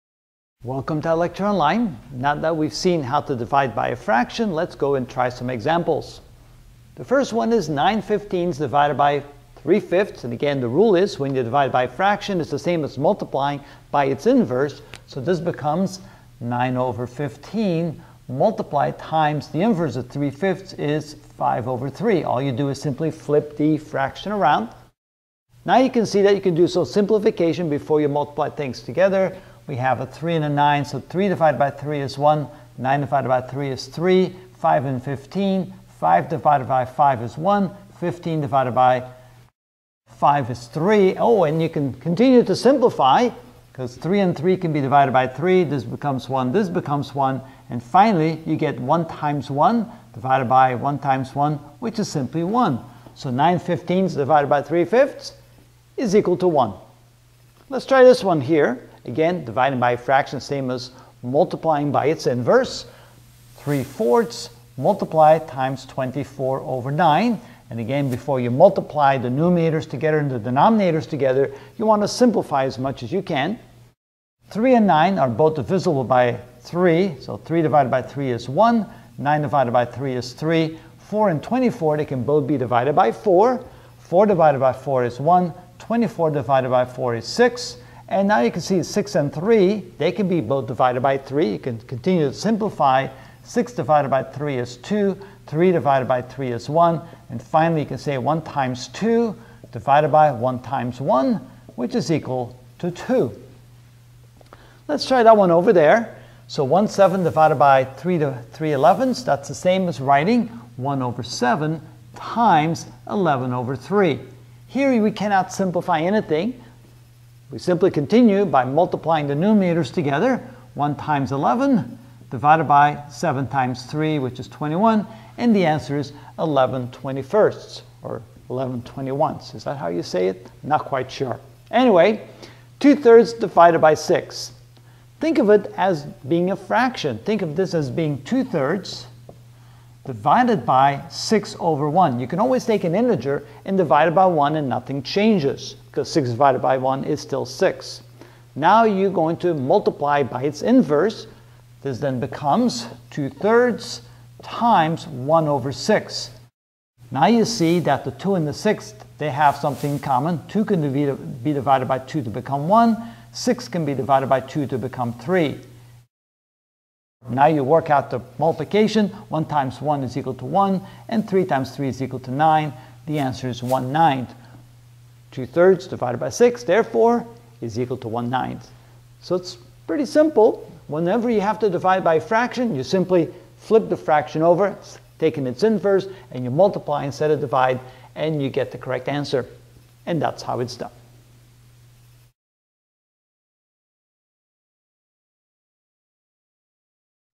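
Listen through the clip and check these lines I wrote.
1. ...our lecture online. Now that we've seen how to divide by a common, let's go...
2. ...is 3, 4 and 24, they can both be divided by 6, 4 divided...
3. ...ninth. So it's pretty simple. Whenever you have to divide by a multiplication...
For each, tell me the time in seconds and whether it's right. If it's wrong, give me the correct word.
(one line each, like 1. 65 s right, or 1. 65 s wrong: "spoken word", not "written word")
1. 1 s wrong: "fraction", not "common"
2. 80 s wrong: "4", not "6"
3. 178 s wrong: "fraction", not "multiplication".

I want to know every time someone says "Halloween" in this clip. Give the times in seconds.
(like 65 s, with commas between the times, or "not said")
not said.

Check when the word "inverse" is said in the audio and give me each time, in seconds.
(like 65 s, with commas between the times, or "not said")
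14 s, 19 s, 62 s, 150 s, 185 s.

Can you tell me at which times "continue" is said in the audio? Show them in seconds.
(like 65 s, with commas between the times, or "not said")
41 s, 91 s, 117 s.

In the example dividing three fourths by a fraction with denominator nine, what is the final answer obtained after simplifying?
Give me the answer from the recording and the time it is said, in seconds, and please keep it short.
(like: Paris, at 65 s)
2, at 101 s.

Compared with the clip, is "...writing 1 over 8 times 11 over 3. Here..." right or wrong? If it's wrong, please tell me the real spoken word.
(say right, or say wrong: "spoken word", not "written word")
wrong: "7", not "8".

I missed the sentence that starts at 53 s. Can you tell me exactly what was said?
So 9 fifteenths divided by 3 fifths is equal to 1.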